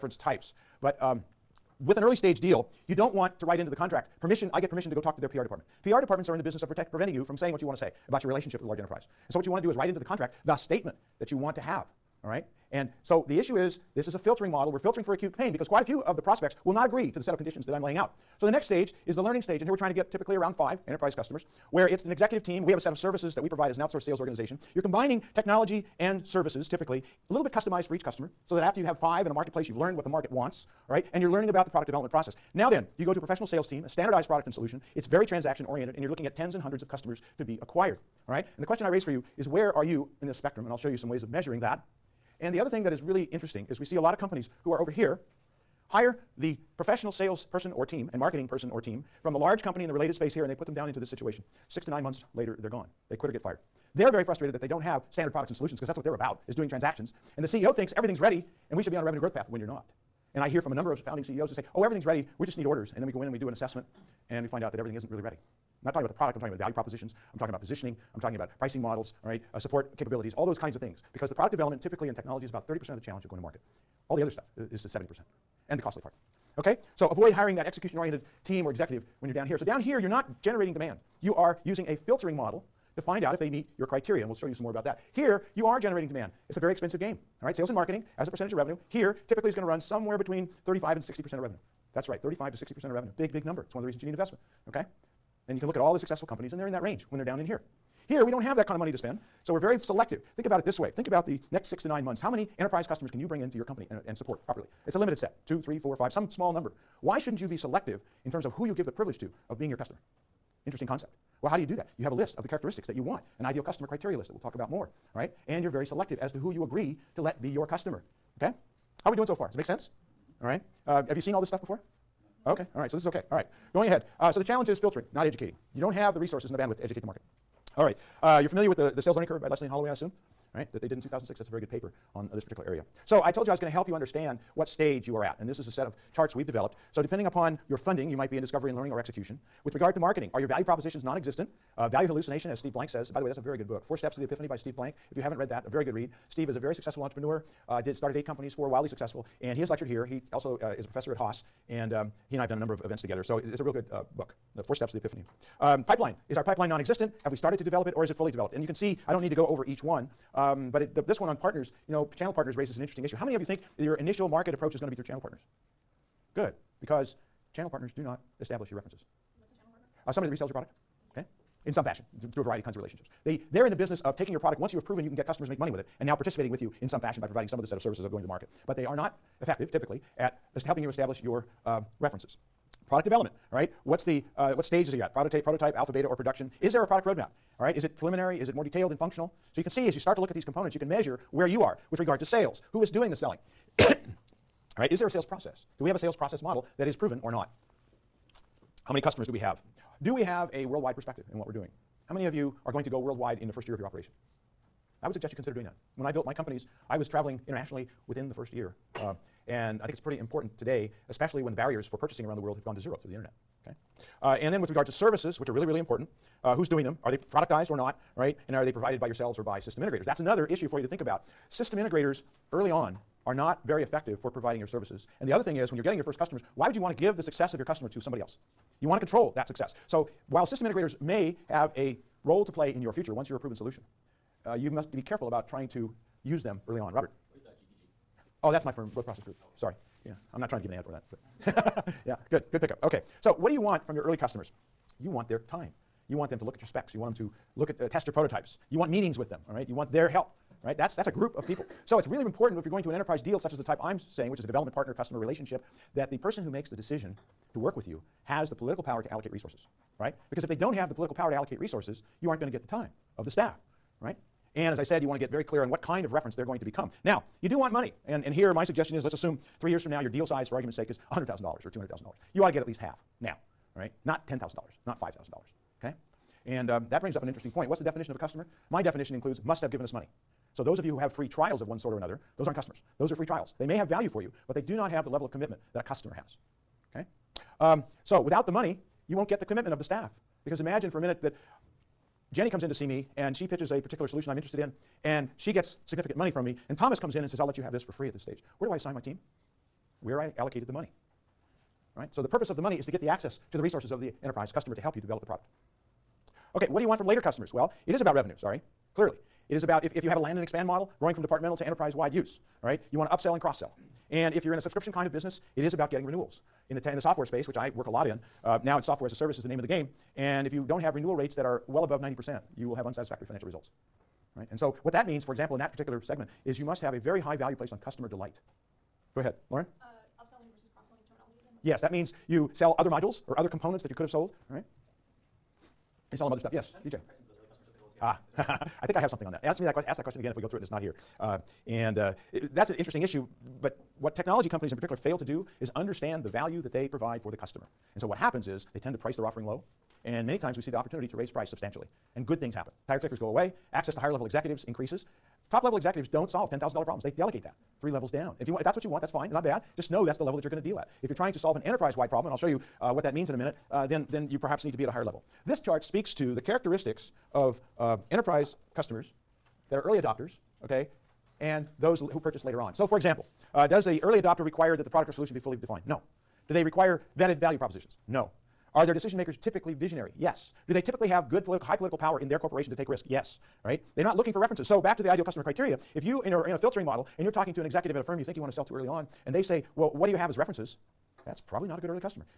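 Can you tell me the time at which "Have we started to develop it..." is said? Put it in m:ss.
2:37.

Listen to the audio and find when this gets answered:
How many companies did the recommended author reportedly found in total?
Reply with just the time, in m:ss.
2:28.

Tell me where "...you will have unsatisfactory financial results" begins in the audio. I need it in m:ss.
5:22.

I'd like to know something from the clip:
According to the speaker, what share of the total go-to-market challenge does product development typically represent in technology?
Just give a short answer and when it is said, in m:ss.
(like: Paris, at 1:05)
30%, at 1:12.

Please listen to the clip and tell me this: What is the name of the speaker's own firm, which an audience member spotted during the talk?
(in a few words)
Growth Process Group.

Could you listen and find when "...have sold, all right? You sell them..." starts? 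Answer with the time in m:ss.
5:34.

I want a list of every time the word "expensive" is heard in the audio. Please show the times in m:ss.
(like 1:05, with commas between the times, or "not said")
1:26.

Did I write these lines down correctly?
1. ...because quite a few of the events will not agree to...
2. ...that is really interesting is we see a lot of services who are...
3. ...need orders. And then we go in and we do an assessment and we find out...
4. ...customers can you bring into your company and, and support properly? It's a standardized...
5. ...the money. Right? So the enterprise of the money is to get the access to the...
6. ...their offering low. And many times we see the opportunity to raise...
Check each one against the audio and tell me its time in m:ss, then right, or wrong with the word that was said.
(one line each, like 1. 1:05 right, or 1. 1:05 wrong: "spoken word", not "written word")
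1. 0:15 wrong: "prospects", not "events"
2. 0:42 wrong: "companies", not "services"
3. 1:02 right
4. 1:42 wrong: "limited", not "standardized"
5. 5:00 wrong: "purpose", not "enterprise"
6. 5:49 right.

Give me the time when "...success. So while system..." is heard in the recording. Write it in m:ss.
3:49.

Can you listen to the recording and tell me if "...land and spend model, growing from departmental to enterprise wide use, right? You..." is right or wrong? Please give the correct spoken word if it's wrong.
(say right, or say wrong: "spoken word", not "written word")
wrong: "expand", not "spend".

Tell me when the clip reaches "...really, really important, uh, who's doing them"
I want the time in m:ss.
3:35.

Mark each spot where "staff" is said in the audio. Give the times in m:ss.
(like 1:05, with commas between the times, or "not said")
4:23, 4:49.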